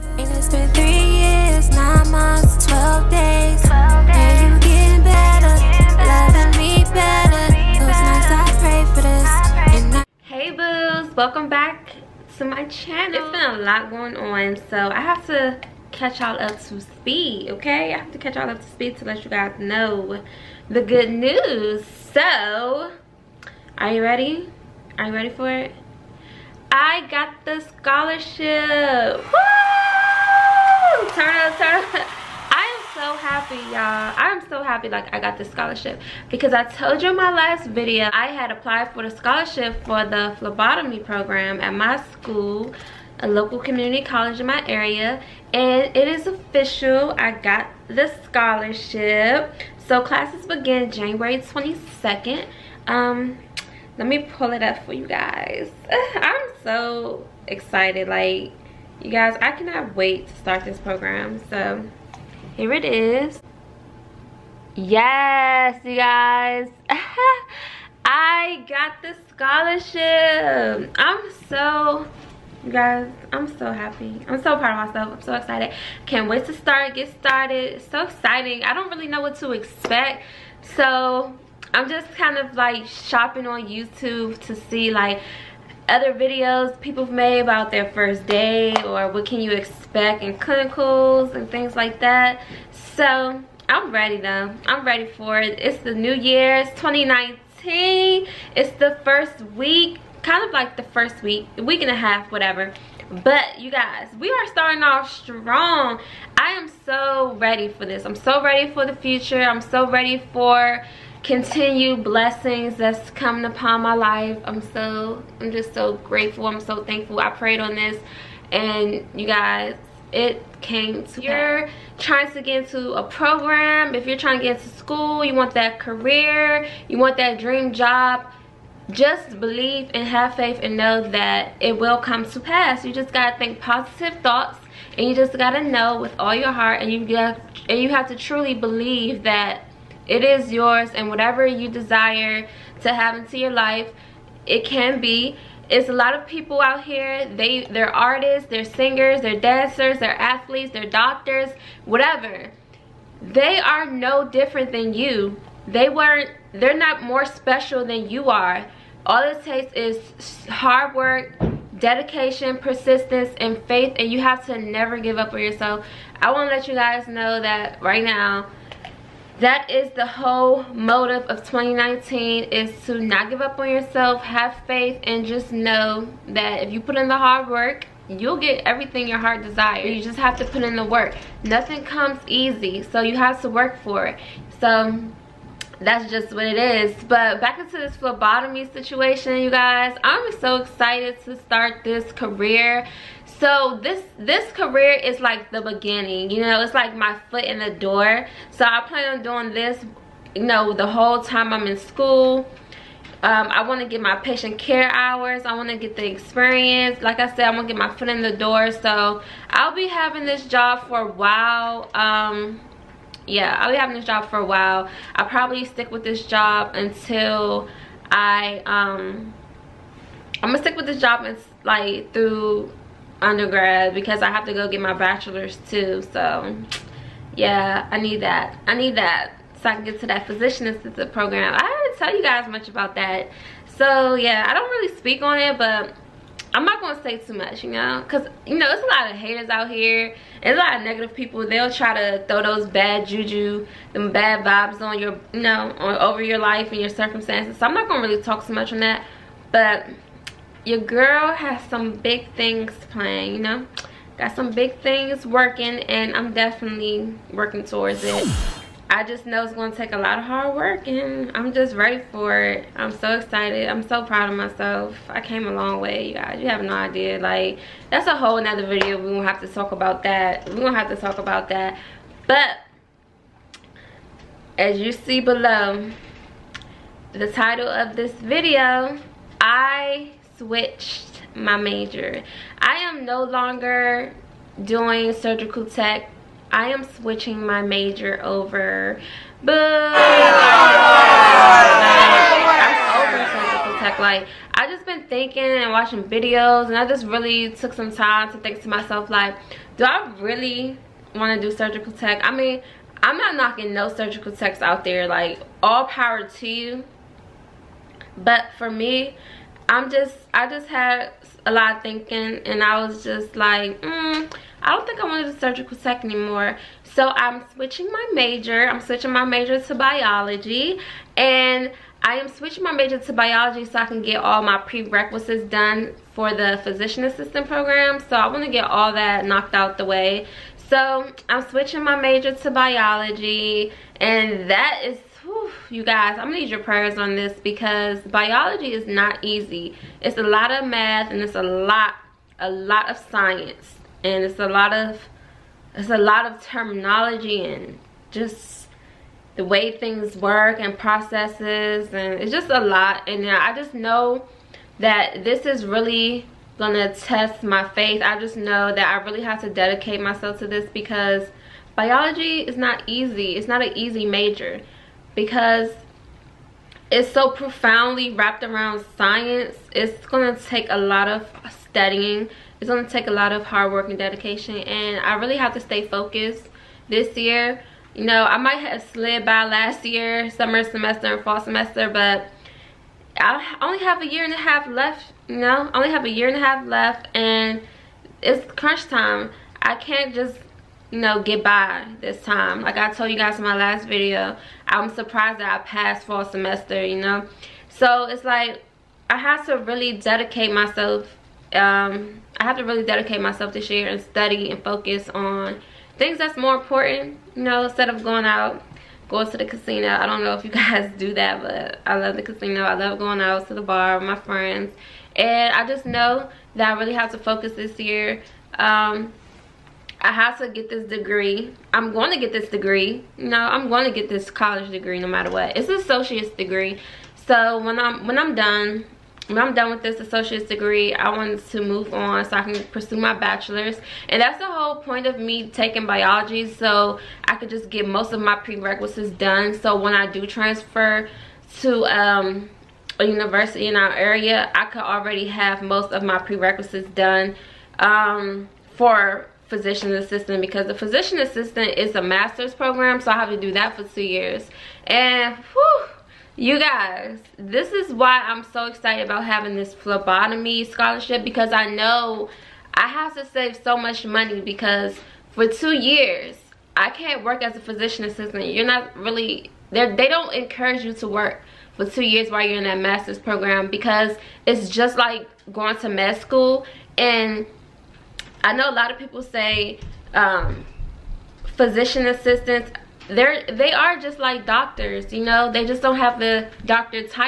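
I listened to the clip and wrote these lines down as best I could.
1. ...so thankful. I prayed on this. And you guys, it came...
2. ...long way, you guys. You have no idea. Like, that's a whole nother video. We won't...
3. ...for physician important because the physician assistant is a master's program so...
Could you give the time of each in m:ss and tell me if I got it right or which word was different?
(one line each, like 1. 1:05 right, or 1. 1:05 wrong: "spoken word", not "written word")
1. 1:56 right
2. 4:25 right
3. 7:28 wrong: "assistant", not "important".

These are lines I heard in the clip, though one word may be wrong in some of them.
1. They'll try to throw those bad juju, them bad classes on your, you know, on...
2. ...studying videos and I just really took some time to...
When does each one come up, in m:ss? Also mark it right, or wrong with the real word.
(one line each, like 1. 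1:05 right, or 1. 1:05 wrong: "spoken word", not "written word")
1. 4:01 wrong: "vibes", not "classes"
2. 4:55 wrong: "watching", not "studying".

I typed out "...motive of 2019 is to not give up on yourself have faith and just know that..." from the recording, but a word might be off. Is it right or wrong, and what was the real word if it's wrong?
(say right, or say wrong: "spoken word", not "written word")
right.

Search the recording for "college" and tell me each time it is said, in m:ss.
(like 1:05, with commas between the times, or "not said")
0:44, 7:04.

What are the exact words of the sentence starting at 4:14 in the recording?
Got some big things working and I'm definitely working towards it.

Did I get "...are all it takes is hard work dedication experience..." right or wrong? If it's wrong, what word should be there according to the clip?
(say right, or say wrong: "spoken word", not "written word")
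wrong: "persistence", not "experience".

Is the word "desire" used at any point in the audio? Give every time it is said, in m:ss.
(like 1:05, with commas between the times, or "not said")
2:21, 2:59.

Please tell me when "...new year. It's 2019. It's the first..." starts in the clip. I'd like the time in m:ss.
1:35.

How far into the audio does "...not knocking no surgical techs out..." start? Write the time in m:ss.
5:03.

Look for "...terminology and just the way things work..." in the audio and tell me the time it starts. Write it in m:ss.
5:46.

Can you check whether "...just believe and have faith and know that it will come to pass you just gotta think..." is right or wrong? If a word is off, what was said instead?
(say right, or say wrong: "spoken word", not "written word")
right.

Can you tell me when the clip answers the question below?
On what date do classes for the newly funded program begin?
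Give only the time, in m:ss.
0:50.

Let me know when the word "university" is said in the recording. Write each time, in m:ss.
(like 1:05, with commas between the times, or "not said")
7:23.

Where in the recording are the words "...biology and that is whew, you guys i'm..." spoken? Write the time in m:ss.
5:32.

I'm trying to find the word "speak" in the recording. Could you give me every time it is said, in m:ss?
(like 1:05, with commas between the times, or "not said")
3:54.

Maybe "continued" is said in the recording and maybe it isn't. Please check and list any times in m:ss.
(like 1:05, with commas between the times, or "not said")
1:51.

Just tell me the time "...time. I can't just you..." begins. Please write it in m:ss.
6:28.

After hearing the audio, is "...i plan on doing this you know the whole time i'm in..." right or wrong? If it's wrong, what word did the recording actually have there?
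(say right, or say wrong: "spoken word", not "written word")
right.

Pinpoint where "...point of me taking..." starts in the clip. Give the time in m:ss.
7:14.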